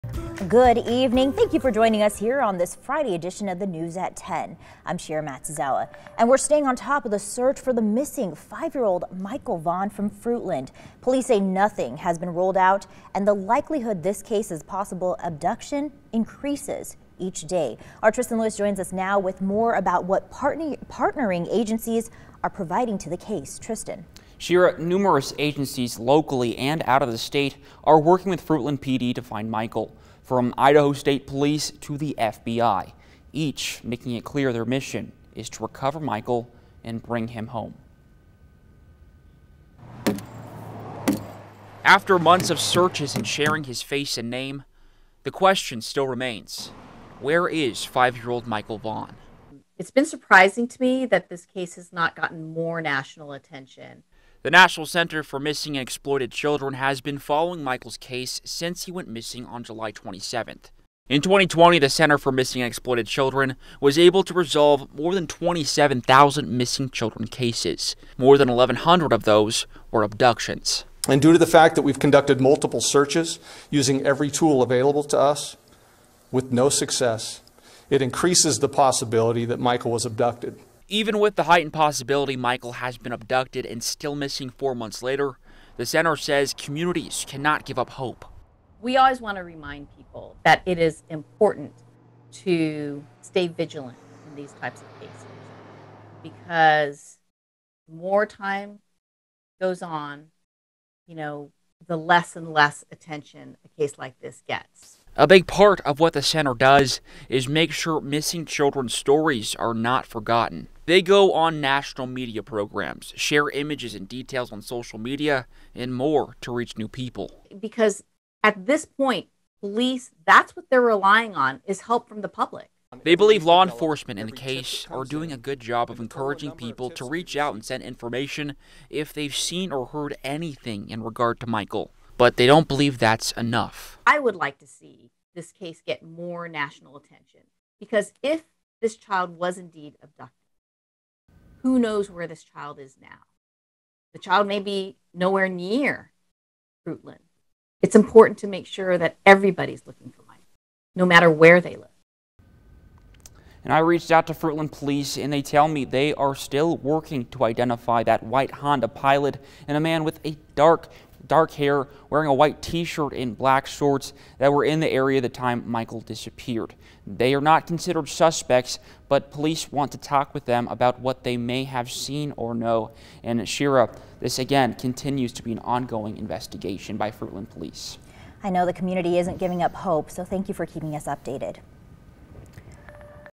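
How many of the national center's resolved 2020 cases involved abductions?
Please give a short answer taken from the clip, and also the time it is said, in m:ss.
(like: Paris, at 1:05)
1,100, at 1:08.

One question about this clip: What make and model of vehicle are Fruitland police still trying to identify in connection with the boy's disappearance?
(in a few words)
Honda Pilot.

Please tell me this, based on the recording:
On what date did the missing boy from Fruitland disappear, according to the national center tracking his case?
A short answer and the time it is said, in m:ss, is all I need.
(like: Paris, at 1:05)
July 27, at 0:59.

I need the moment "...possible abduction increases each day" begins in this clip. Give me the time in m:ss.
0:14.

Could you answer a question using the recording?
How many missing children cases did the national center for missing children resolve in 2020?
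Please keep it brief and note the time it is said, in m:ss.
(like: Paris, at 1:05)
27,000, at 1:05.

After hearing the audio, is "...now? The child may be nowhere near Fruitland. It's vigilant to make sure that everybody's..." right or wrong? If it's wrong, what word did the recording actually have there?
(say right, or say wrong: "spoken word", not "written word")
wrong: "important", not "vigilant".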